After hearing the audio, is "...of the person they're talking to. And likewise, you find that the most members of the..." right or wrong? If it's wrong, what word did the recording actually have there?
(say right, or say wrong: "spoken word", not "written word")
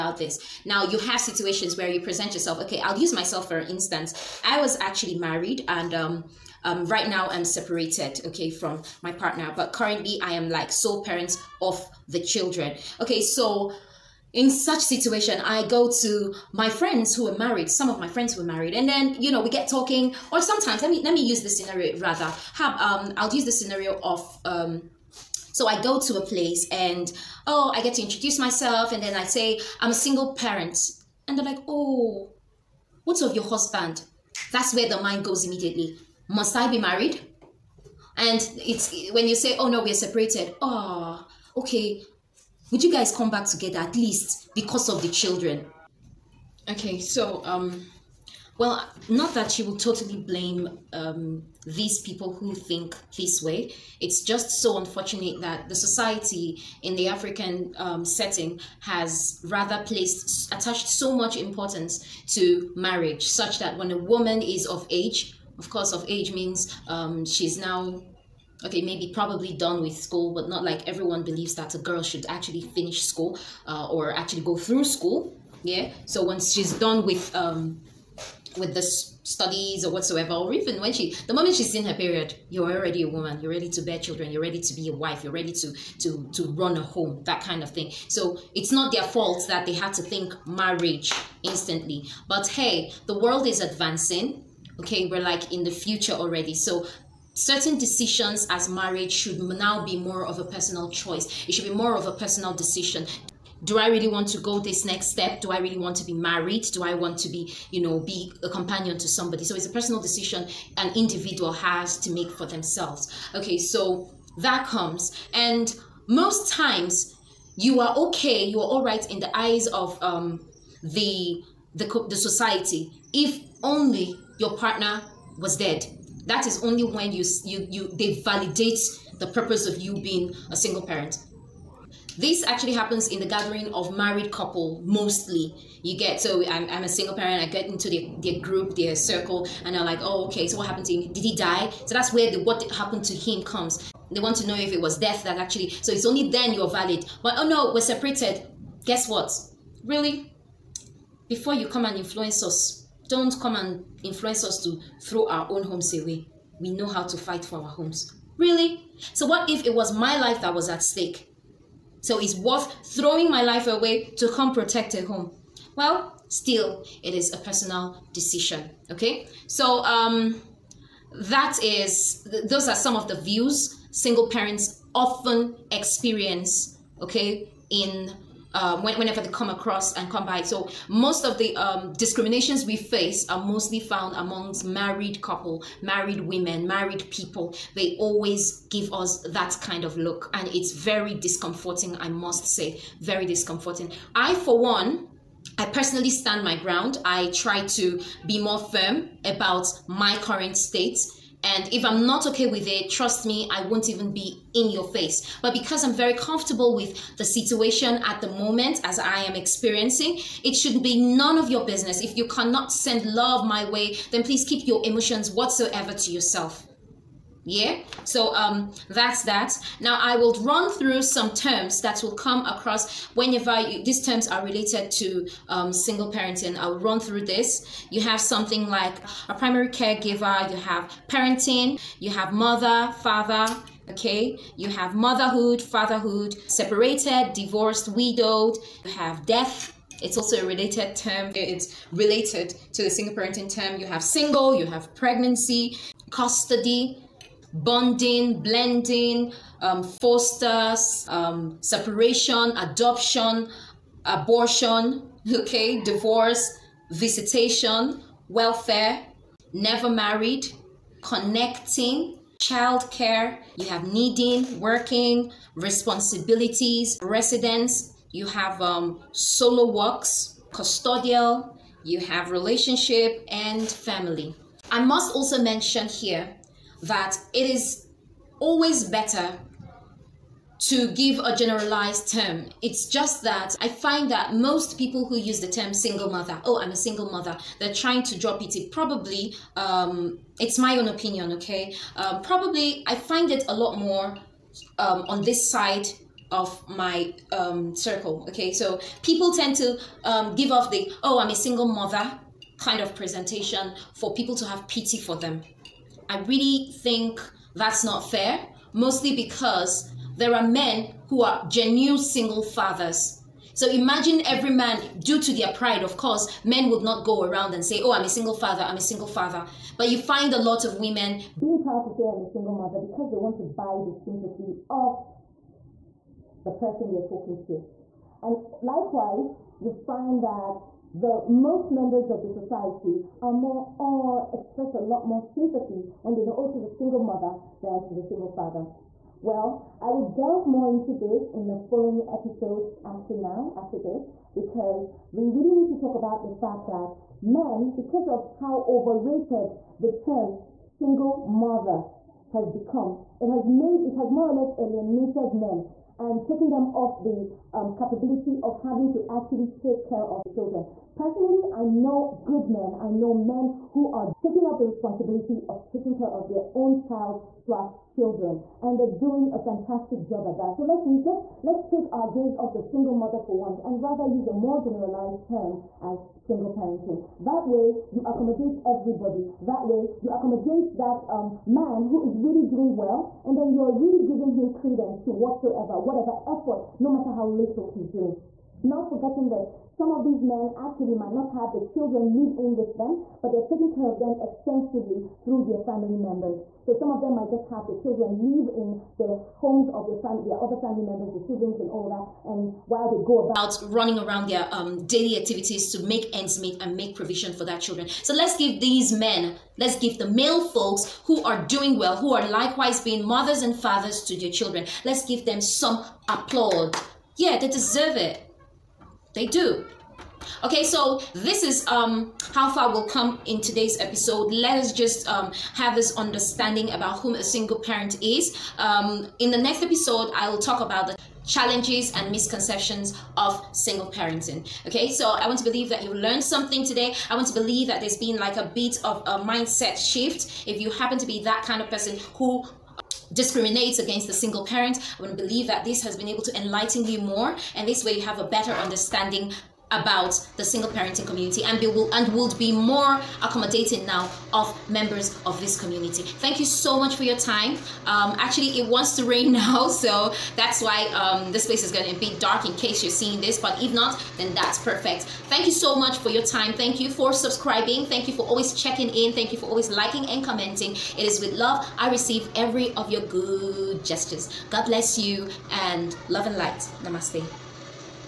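right.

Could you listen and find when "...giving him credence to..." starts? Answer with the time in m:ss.
6:24.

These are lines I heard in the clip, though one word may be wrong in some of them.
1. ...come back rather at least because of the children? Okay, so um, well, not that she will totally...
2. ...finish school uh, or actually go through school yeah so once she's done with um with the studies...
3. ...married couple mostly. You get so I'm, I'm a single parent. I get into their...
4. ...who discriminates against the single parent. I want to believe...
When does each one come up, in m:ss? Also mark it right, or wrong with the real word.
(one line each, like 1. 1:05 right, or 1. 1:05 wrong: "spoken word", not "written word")
1. 0:43 wrong: "together", not "rather"
2. 1:12 right
3. 2:13 right
4. 7:22 right.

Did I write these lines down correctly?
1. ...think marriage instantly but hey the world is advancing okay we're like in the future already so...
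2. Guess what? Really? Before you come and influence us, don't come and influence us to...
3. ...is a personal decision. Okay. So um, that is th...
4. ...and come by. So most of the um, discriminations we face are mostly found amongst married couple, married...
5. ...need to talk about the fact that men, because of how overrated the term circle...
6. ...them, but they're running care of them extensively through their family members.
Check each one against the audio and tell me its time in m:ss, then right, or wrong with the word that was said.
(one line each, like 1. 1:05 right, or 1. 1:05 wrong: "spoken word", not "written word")
1. 1:30 right
2. 2:28 right
3. 2:47 right
4. 2:59 right
5. 5:45 wrong: "single", not "circle"
6. 6:32 wrong: "taking", not "running".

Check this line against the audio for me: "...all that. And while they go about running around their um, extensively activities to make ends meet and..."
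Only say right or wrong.
wrong.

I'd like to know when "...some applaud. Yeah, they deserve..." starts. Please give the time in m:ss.
6:55.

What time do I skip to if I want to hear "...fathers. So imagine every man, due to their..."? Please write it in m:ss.
5:12.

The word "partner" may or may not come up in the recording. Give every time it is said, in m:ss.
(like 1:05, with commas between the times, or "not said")
0:09, 2:04.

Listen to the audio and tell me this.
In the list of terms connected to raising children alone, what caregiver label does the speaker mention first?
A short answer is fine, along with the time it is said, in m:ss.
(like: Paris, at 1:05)
primary caregiver, at 3:49.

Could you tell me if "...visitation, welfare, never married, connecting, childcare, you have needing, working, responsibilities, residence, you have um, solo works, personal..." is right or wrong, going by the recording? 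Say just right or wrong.
wrong.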